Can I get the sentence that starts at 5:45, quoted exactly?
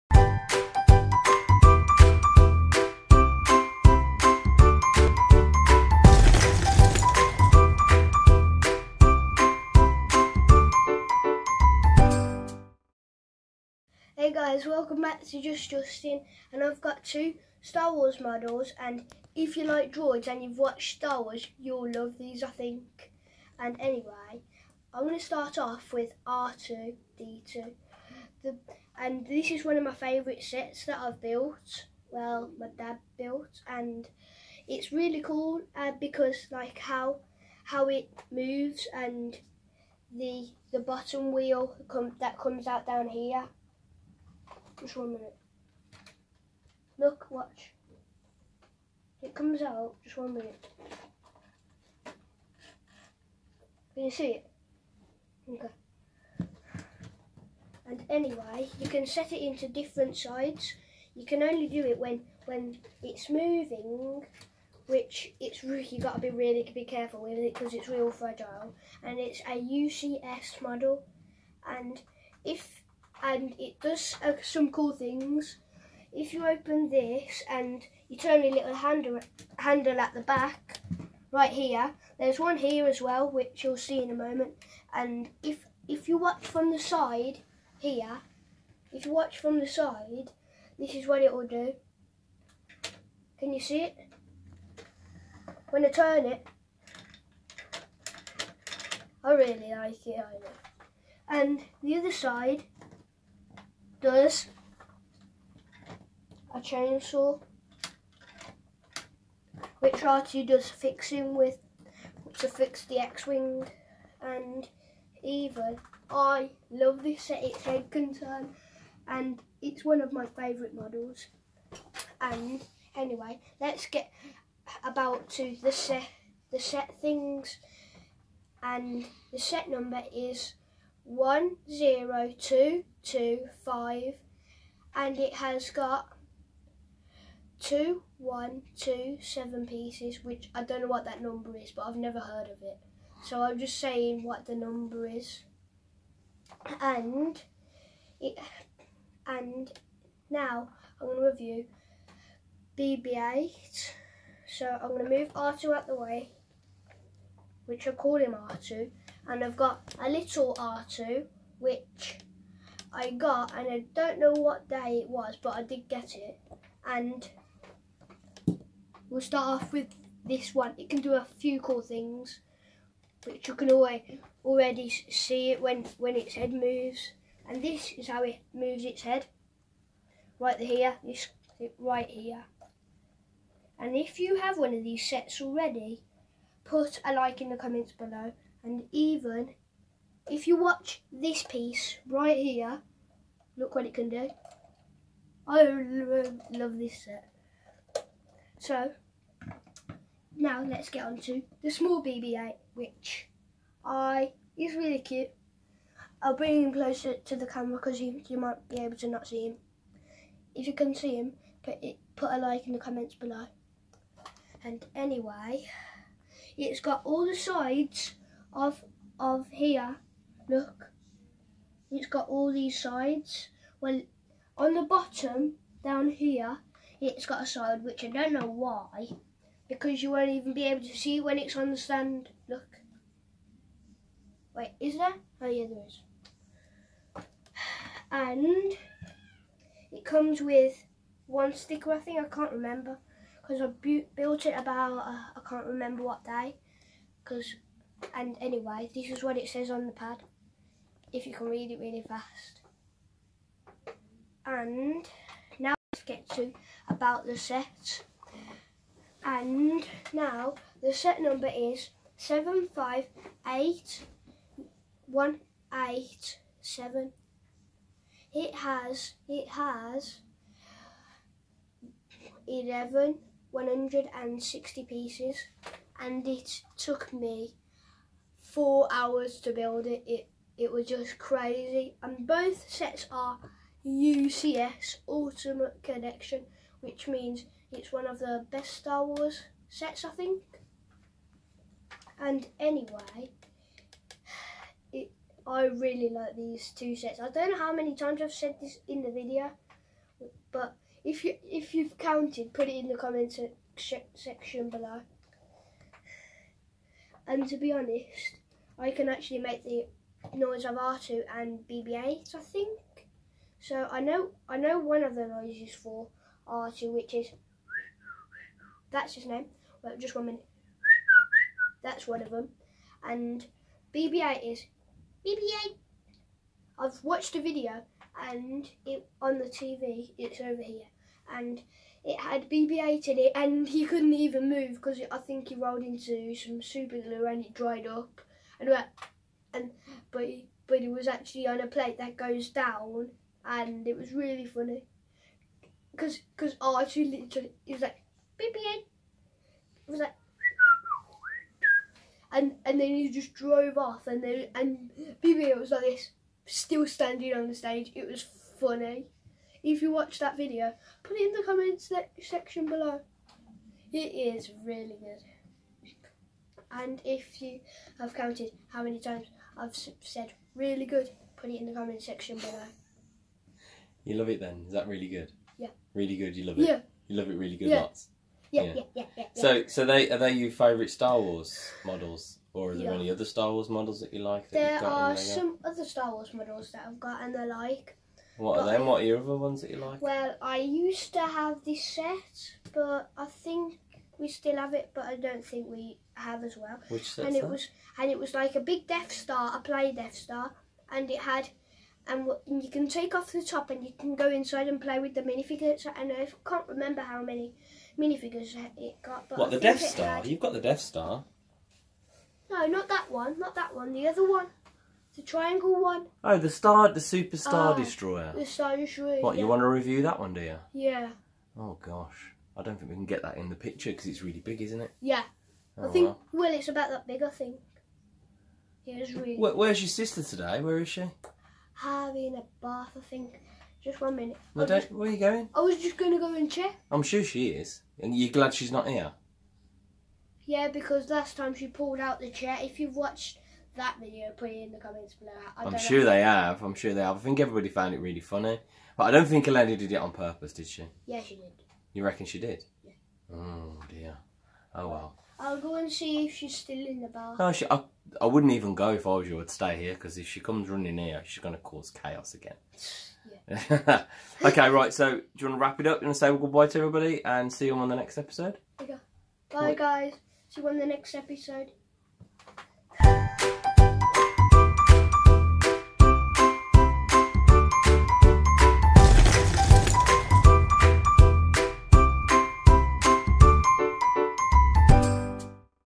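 Cause cause I actually literally it was like beep beep.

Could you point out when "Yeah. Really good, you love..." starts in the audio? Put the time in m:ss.
6:15.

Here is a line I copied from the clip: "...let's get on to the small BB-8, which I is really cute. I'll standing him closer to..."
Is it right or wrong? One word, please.
wrong.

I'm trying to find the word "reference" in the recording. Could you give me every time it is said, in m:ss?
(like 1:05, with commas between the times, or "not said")
not said.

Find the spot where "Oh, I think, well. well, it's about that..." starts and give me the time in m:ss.
7:05.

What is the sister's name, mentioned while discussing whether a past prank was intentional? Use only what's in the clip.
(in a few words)
Elena.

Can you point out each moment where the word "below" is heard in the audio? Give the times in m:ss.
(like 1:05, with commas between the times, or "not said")
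3:07, 3:33, 5:04, 6:02, 6:12, 7:25.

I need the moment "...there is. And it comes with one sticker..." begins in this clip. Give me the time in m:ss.
3:55.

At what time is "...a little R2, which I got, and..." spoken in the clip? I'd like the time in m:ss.
2:40.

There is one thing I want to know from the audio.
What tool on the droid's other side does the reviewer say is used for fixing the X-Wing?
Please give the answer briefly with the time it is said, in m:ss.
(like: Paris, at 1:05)
A chainsaw, at 1:46.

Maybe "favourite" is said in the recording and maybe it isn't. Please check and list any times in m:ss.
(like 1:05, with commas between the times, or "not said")
0:29, 2:00, 6:20.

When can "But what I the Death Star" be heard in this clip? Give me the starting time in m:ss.
6:49.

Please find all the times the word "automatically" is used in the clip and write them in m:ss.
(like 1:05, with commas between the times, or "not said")
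not said.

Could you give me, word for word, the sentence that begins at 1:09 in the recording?
And it's a UCS model, and if and it does uh, some cool things.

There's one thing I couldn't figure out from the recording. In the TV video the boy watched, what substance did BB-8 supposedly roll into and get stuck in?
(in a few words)
Super glue.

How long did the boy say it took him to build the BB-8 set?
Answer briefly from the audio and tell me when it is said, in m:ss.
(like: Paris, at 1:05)
Four hours, at 4:38.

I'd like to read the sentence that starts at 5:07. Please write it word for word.
And to be honest, I can actually make the noise of R2 and BB8, I think.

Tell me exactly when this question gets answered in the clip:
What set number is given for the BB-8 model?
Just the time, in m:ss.
4:22.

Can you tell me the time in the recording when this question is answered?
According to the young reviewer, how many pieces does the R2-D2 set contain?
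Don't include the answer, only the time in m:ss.
2:17.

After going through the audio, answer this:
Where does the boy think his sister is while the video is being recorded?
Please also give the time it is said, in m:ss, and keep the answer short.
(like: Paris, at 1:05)
Having a bath, at 7:11.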